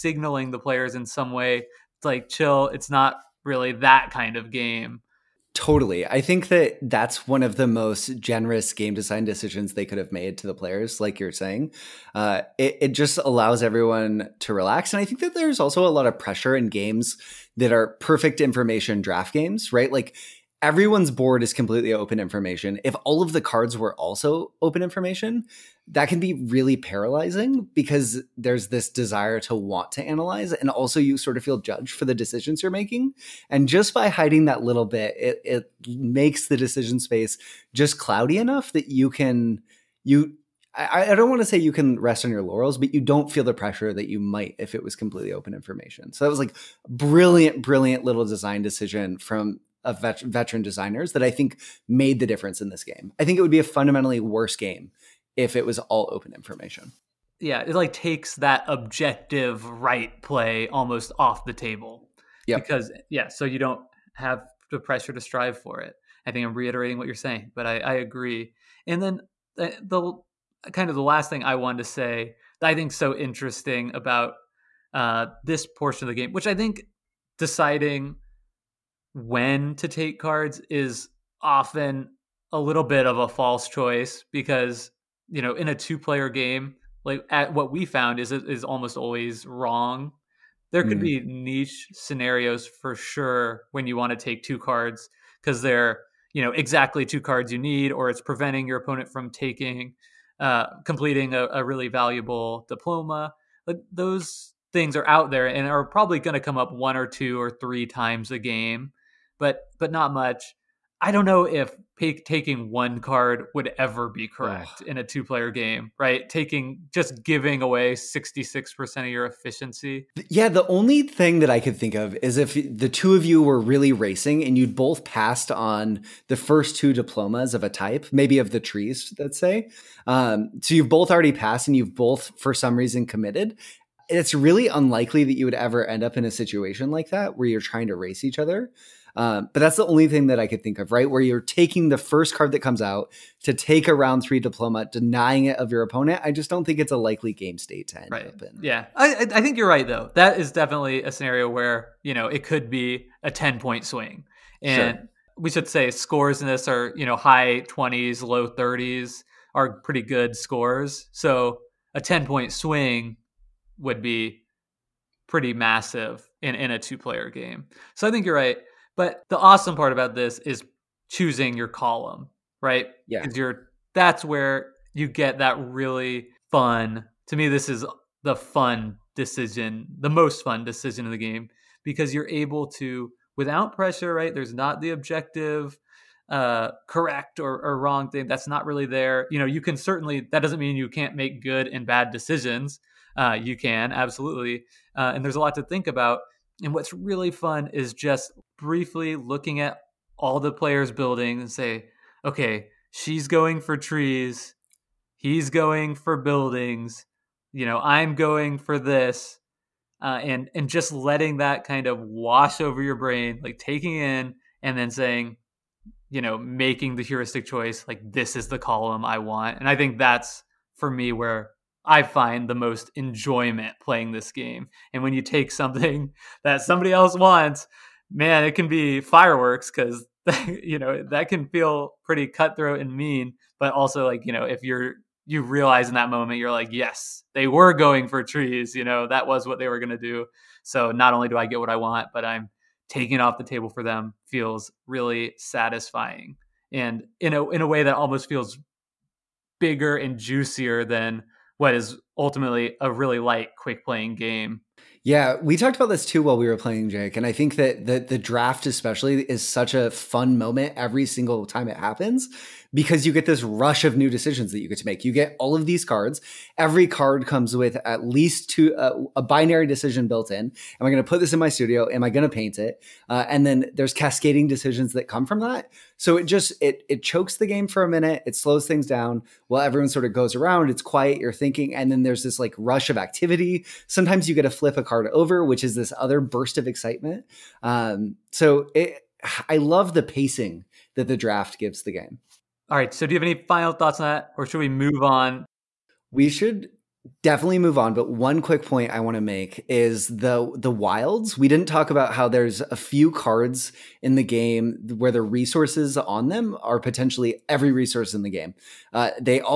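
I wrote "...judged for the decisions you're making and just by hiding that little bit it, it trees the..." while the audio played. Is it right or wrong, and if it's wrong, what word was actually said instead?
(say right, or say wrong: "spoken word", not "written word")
wrong: "makes", not "trees".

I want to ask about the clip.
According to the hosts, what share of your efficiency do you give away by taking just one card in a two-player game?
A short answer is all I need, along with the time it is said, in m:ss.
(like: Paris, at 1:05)
66%, at 1:57.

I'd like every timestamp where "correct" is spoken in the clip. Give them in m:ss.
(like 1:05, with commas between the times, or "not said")
1:54, 3:06.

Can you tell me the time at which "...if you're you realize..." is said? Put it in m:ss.
3:54.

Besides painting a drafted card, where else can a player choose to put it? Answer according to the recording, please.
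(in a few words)
studio.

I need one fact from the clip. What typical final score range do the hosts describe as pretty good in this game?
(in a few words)
high twenties, low thirties.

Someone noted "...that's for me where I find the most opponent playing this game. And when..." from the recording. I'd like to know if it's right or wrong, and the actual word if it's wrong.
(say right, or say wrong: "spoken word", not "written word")
wrong: "enjoyment", not "opponent".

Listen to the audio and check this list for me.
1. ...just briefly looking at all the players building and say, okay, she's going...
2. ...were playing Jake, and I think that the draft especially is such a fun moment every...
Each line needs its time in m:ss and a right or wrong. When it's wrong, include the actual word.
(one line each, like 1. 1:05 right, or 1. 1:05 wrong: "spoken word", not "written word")
1. 3:17 right
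2. 4:16 right.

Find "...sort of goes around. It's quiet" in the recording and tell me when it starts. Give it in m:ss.
4:39.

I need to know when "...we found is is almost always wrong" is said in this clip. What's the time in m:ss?
1:27.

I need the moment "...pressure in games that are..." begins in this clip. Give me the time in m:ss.
0:16.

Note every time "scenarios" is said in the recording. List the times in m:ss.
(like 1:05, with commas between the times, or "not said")
1:31, 2:31.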